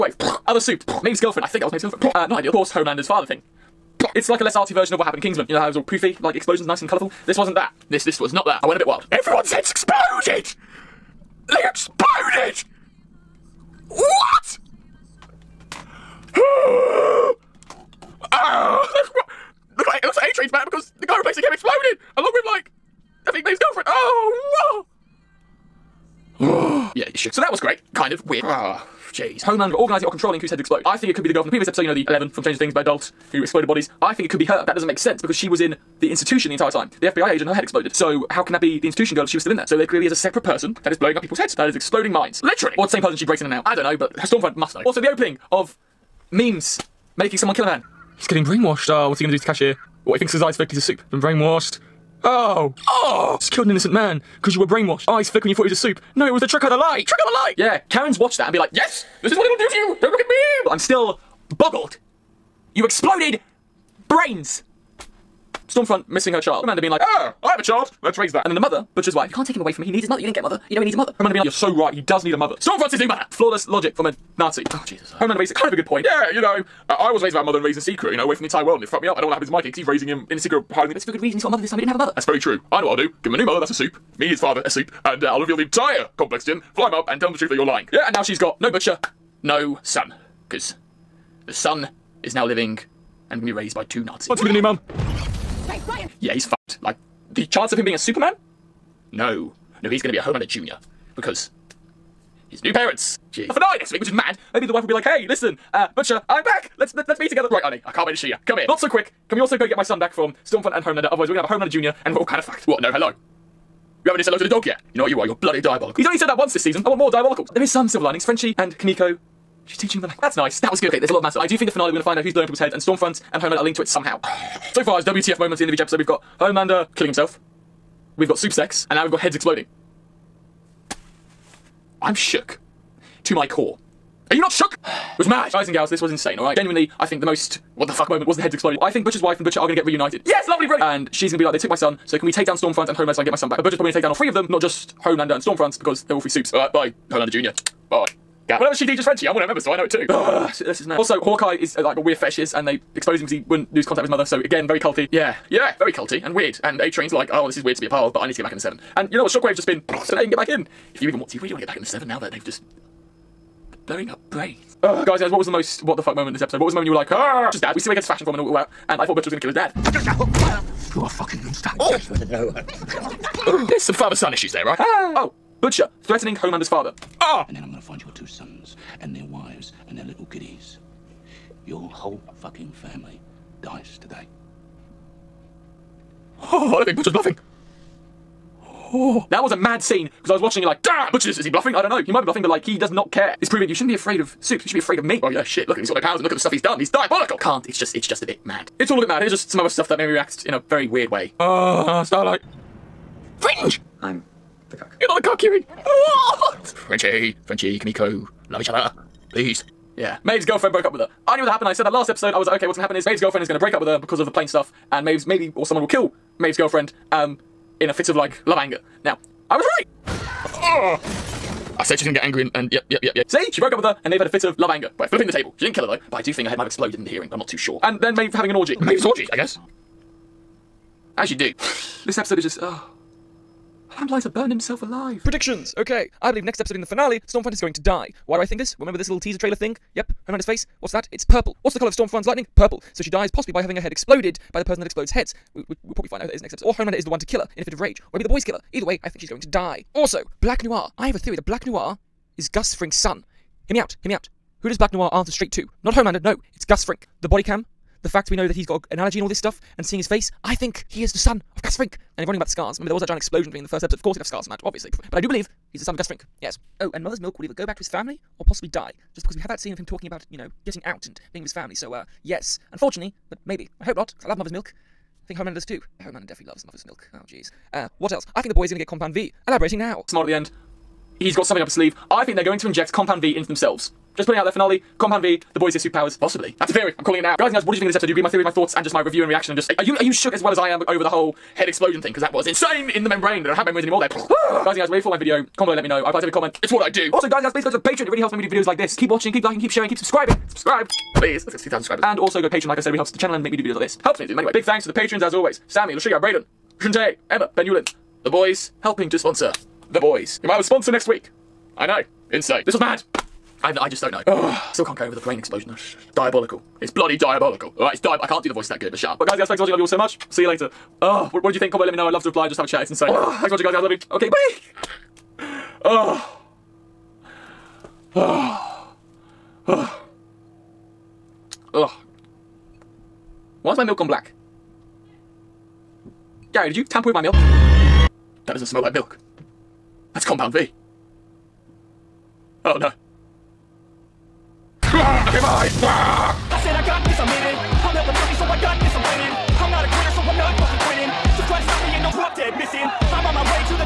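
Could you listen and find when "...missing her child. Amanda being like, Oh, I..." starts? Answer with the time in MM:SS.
01:06.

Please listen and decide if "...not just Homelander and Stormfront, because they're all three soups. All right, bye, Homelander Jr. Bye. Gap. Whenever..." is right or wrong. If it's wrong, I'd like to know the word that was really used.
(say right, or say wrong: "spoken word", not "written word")
right.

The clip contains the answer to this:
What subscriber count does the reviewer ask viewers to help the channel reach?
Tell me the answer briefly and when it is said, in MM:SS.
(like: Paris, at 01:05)
2,000, at 05:01.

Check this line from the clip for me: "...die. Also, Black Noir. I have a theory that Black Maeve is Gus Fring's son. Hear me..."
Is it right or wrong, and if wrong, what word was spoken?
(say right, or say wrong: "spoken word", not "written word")
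wrong: "Noir", not "Maeve".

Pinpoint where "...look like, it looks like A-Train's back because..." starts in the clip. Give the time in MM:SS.
00:19.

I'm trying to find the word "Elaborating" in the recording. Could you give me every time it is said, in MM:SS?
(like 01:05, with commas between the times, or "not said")
04:39.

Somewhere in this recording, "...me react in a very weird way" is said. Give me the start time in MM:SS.
03:20.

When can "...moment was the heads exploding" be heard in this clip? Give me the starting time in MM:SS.
02:18.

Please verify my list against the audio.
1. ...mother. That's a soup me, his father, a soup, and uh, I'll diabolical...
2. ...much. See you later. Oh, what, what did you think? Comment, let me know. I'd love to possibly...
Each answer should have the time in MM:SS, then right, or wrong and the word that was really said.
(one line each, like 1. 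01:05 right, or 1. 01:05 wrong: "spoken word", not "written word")
1. 01:23 wrong: "reveal", not "diabolical"
2. 05:19 wrong: "reply", not "possibly".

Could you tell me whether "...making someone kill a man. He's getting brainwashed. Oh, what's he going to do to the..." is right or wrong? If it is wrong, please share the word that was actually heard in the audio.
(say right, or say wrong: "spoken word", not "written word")
right.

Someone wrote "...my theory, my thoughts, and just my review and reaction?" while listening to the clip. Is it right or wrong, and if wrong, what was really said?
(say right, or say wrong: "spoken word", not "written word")
right.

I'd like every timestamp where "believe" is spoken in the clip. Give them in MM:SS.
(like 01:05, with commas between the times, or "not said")
03:56, 04:25.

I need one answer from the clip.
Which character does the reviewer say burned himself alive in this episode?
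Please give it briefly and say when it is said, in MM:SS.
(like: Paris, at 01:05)
Lamplighter, at 03:53.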